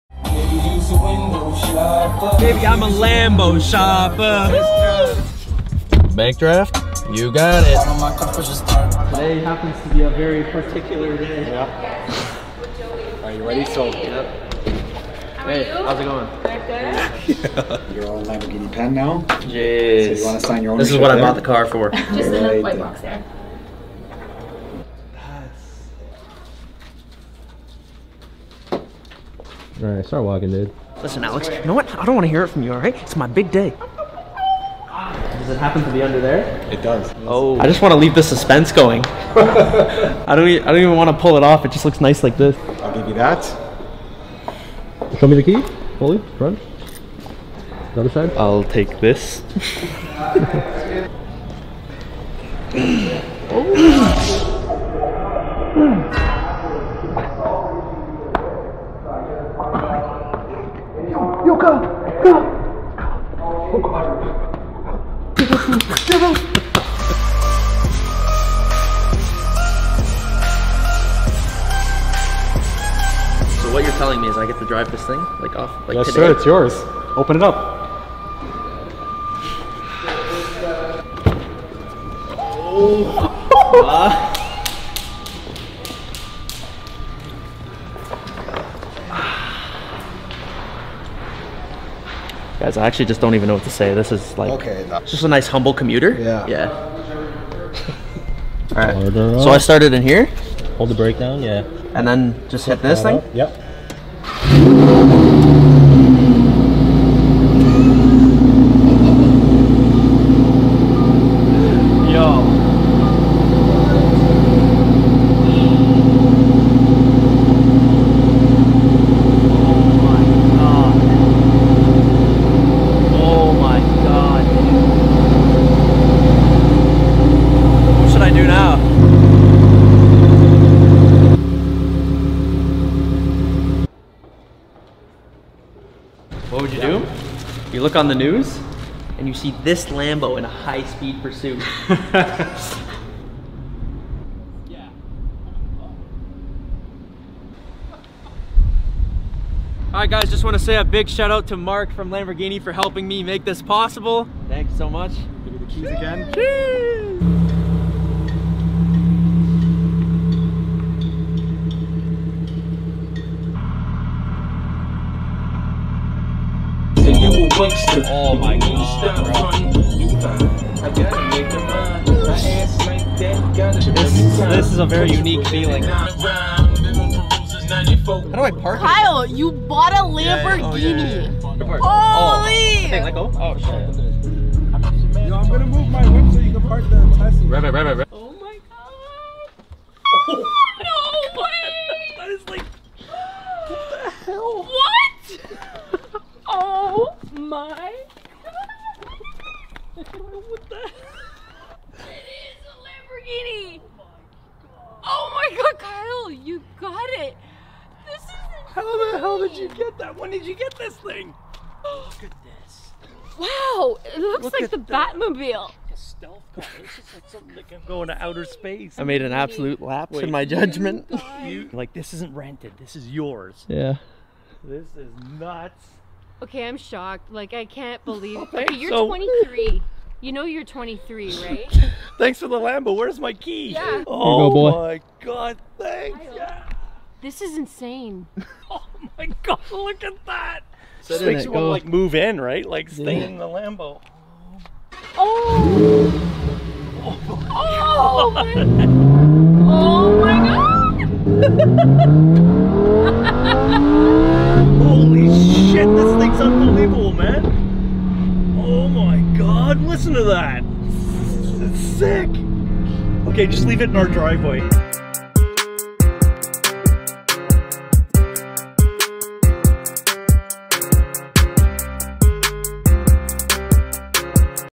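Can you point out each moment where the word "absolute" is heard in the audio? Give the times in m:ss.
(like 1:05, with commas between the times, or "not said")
3:39.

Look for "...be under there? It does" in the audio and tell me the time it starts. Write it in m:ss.
0:35.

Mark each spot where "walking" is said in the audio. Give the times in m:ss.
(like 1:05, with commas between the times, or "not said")
0:30.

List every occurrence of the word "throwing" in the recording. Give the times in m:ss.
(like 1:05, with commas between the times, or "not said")
not said.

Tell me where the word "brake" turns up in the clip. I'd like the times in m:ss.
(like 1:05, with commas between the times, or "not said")
1:40.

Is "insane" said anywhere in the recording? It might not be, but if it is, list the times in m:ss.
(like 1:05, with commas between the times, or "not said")
3:57.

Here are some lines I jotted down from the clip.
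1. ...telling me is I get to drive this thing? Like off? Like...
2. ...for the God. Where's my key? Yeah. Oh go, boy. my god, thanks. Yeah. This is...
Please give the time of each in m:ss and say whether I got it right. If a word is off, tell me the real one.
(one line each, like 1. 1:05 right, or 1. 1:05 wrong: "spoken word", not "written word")
1. 1:13 right
2. 3:52 wrong: "Lambo", not "God".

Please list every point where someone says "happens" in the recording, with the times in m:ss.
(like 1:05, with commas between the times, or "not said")
0:09, 0:35.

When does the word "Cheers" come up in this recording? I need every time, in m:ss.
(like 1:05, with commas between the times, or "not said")
2:36.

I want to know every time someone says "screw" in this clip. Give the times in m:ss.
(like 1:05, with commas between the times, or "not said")
not said.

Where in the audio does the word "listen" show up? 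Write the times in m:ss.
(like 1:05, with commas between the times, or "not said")
0:31, 4:19.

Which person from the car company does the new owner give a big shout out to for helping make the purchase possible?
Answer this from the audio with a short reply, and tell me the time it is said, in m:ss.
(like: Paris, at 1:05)
Mark, at 2:31.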